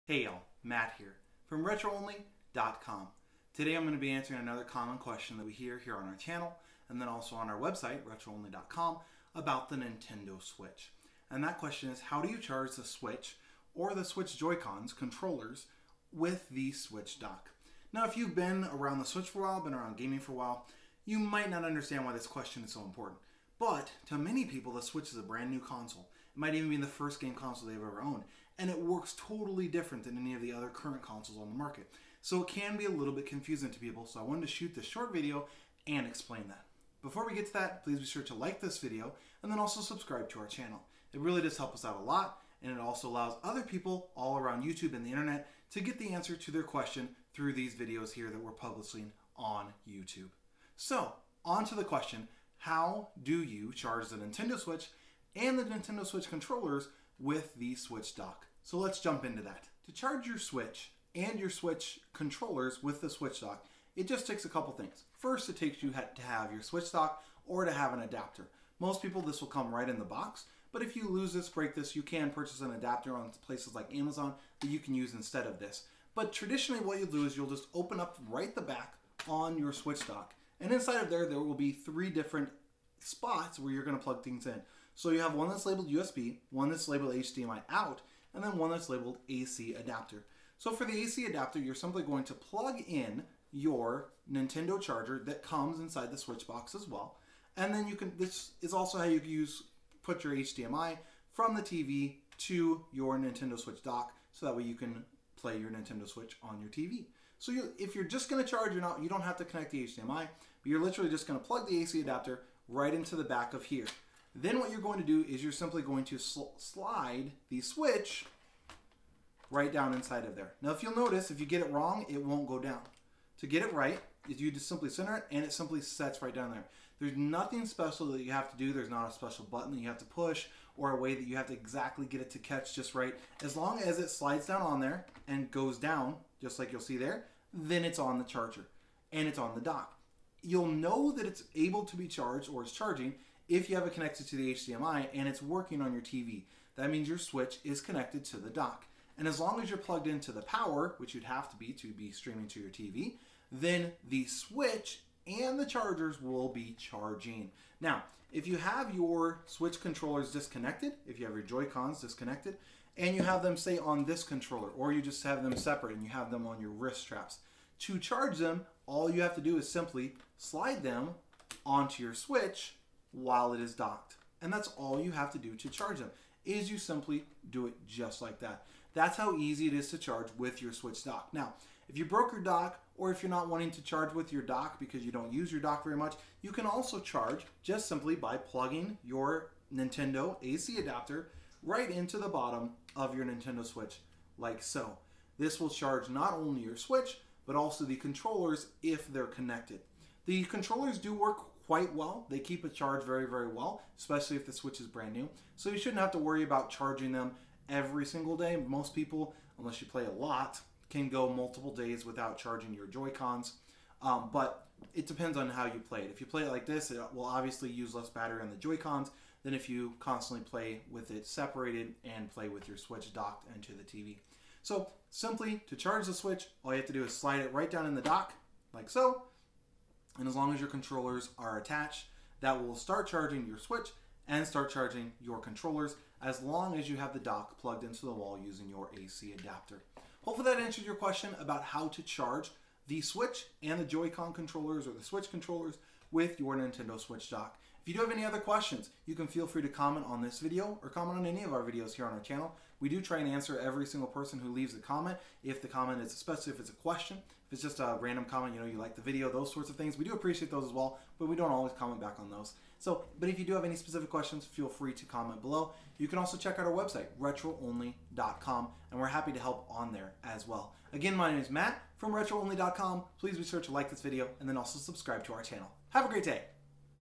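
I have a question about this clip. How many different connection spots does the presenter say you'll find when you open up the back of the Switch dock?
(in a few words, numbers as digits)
3.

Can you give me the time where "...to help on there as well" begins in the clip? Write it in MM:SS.
04:29.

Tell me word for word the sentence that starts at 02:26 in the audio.
That means your switch is connected to the dock.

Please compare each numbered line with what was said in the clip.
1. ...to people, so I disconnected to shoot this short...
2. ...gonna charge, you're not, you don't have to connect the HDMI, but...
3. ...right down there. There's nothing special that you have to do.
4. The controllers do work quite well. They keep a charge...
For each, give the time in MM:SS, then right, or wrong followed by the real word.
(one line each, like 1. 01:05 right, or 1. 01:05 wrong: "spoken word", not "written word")
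1. 00:33 wrong: "wanted", not "disconnected"
2. 01:48 right
3. 02:06 right
4. 03:20 right.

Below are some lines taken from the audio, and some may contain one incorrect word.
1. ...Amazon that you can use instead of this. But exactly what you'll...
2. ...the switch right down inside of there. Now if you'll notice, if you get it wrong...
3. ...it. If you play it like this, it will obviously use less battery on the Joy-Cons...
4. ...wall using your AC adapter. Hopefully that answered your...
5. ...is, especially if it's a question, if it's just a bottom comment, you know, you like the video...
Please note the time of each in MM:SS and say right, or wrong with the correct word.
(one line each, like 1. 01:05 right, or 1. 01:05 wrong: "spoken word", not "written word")
1. 01:13 wrong: "traditionally", not "exactly"
2. 01:57 right
3. 03:36 right
4. 03:58 right
5. 04:16 wrong: "random", not "bottom".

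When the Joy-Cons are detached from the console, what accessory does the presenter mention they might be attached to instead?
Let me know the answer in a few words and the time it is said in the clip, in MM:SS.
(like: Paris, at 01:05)
wrist straps, at 02:46.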